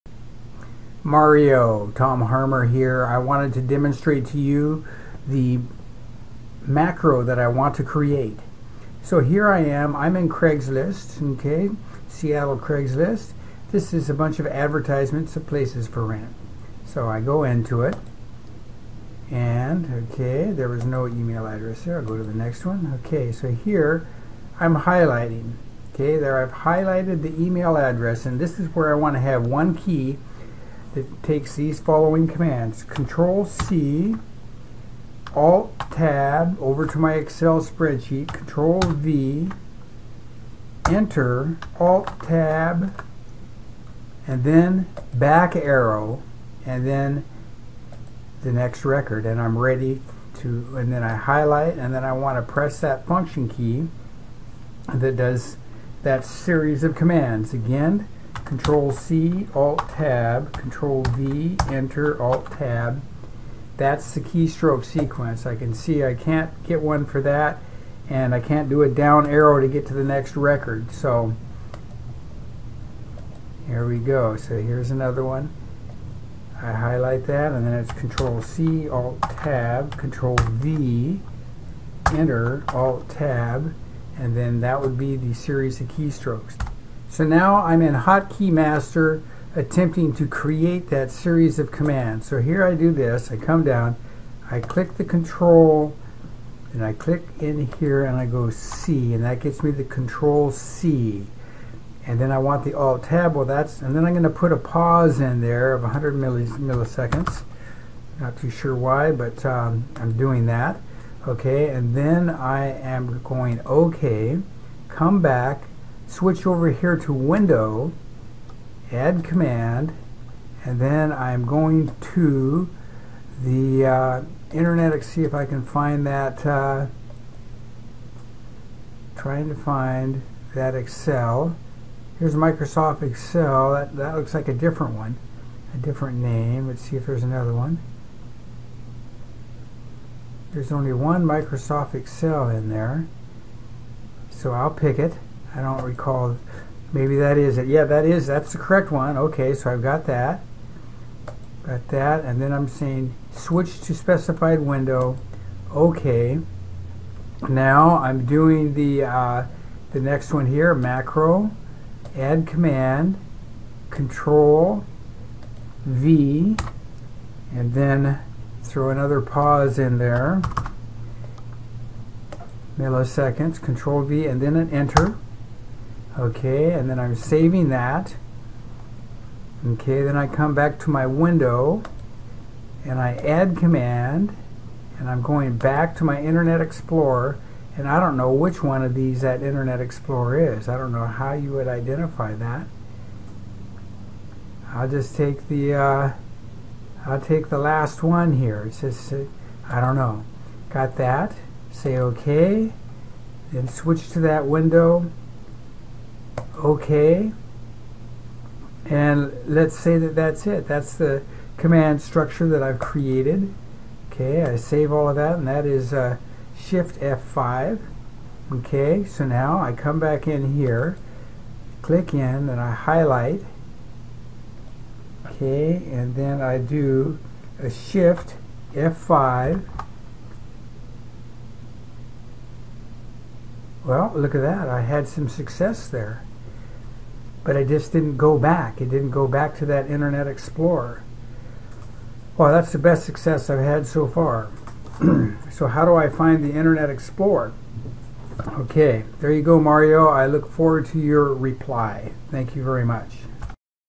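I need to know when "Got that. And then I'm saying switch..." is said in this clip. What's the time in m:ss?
2:31.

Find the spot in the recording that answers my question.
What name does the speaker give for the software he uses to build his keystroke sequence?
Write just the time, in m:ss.
1:27.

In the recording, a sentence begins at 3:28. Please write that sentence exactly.
And let's say that that's it.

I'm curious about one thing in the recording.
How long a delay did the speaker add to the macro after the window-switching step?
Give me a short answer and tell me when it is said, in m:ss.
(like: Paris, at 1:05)
100 milliseconds, at 1:45.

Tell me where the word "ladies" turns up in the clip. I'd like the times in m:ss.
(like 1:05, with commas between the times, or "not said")
not said.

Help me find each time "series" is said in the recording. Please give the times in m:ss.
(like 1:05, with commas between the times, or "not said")
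0:56, 1:25, 1:31.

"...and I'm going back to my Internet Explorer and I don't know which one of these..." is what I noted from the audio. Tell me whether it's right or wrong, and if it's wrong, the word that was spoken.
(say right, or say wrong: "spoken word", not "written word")
right.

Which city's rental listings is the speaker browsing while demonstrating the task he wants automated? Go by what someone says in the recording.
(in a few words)
Seattle.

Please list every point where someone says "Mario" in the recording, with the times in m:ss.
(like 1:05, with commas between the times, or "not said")
0:01, 4:09.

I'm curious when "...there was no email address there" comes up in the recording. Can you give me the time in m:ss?
0:20.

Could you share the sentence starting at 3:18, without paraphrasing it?
It says uh, I don't know.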